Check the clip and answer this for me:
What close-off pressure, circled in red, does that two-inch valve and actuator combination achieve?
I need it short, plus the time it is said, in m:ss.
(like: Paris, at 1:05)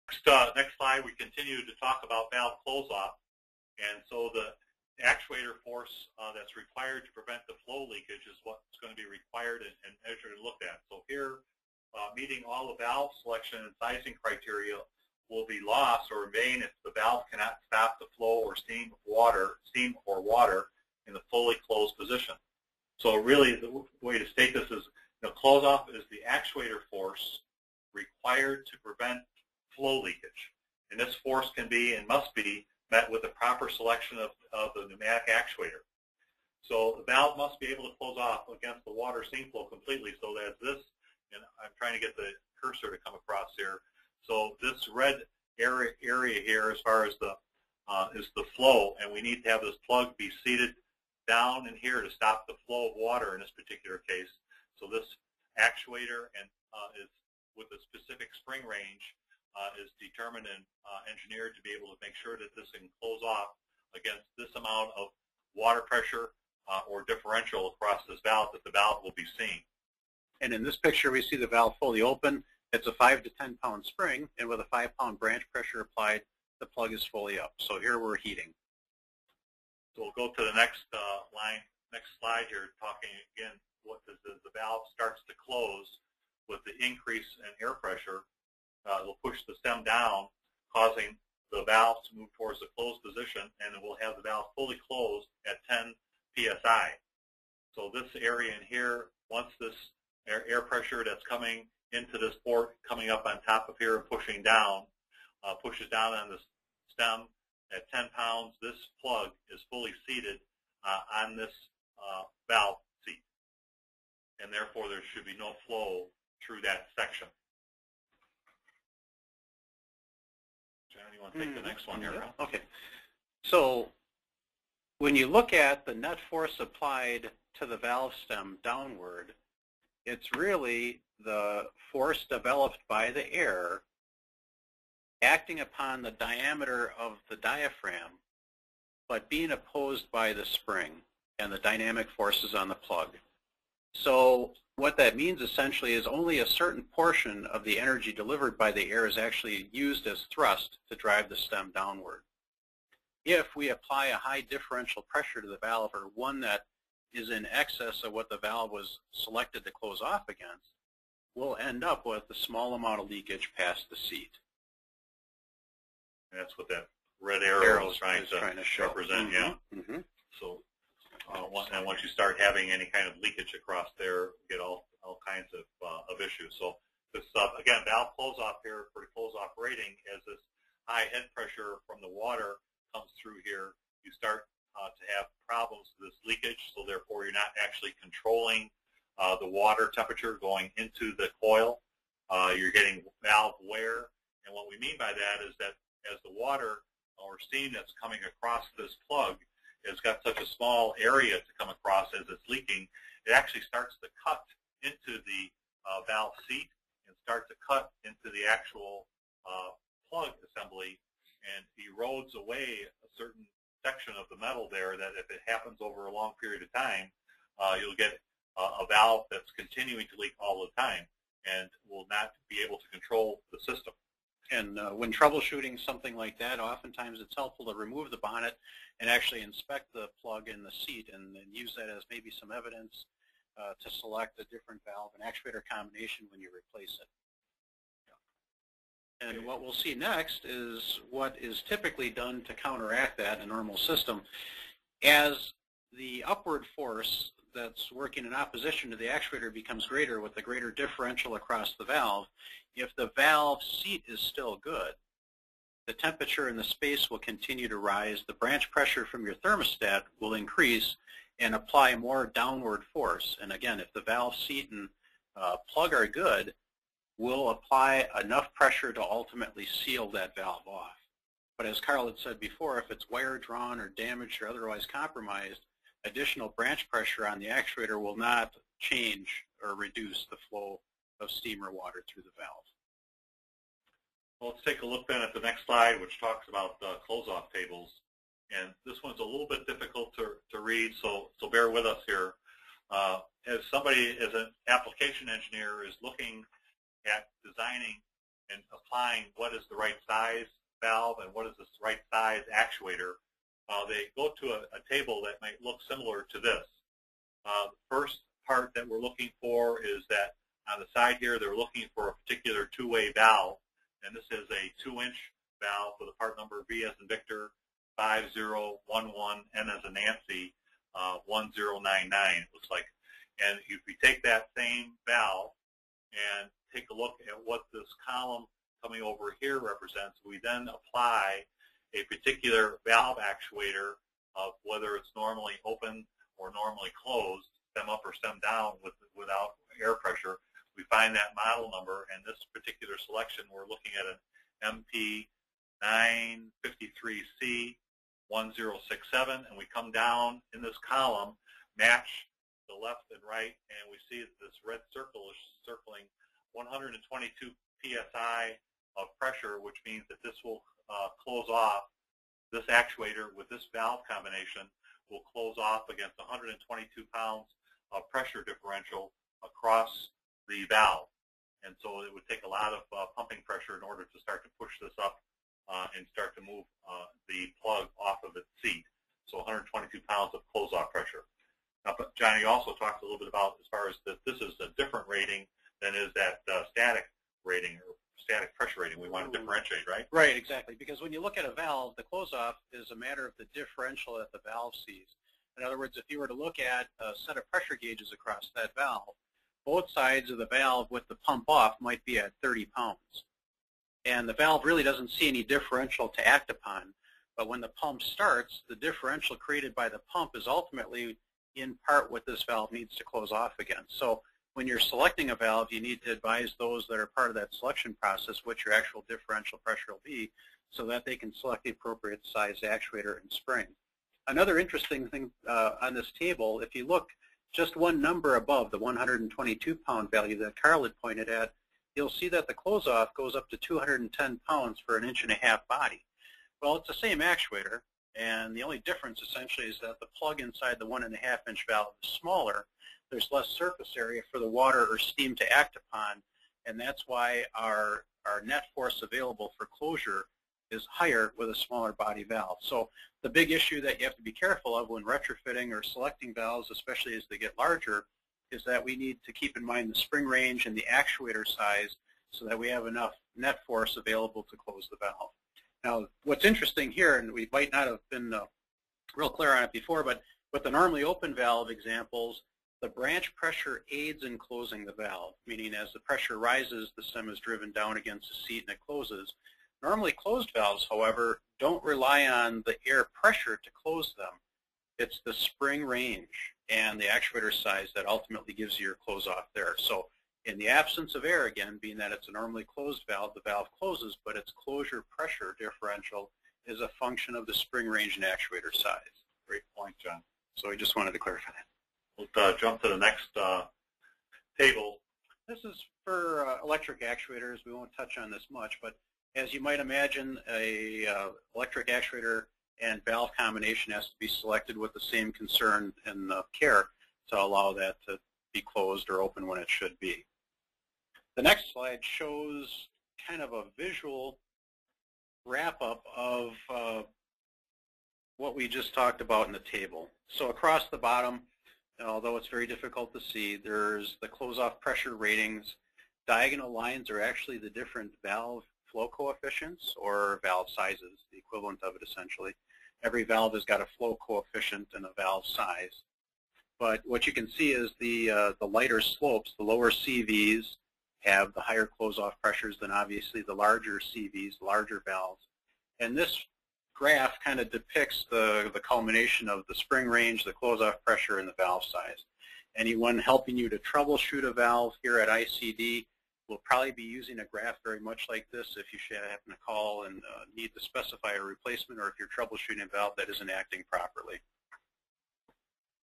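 122 psi, at 5:56.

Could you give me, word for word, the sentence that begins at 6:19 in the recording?
So 122 pounds of close-off pressure.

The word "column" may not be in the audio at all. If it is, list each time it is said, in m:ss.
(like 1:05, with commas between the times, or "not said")
5:28, 5:50.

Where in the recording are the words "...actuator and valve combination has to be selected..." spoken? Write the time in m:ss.
8:31.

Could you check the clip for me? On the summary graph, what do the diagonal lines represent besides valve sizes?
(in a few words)
valve flow coefficients.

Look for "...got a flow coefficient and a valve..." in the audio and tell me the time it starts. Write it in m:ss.
9:03.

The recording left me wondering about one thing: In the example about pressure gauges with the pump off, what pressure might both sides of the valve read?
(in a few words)
30 pounds.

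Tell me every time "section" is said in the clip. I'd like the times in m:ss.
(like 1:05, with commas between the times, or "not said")
1:56, 3:33.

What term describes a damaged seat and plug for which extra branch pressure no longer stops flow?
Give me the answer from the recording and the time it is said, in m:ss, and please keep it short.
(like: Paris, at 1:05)
wire drawn, at 4:33.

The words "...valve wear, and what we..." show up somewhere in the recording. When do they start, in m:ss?
3:13.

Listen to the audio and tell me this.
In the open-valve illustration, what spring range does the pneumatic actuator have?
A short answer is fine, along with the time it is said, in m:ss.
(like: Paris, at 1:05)
5 to 10 pound, at 1:12.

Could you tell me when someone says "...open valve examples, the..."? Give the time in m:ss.
7:51.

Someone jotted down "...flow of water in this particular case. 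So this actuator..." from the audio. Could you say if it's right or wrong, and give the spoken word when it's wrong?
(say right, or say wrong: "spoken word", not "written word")
right.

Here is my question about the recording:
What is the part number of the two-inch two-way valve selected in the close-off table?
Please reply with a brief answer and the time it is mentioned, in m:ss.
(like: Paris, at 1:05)
V5011N1099, at 5:16.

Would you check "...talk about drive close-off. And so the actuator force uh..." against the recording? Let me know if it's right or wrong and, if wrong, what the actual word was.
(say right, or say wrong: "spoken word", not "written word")
wrong: "valve", not "drive".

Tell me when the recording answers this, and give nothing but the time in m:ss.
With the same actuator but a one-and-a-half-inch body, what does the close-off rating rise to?
7:13.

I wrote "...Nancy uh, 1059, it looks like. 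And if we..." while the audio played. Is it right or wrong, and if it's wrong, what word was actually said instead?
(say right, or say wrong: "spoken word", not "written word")
wrong: "1099", not "1059".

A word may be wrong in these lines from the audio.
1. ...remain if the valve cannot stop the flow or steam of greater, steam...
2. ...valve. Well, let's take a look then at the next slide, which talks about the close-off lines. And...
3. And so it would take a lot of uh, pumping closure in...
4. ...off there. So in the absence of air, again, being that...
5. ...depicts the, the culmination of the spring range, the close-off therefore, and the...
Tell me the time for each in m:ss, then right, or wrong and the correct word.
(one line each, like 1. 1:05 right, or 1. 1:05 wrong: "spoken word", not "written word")
1. 0:16 wrong: "water", not "greater"
2. 4:42 wrong: "tables", not "lines"
3. 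6:11 wrong: "pressure", not "closure"
4. 8:09 right
5. 9:17 wrong: "pressure", not "therefore".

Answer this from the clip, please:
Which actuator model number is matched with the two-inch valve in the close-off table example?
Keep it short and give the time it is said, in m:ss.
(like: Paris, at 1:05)
MP953C1067, at 5:45.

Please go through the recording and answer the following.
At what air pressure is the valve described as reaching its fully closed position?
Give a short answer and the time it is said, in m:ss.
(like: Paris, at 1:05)
10 psi, at 1:35.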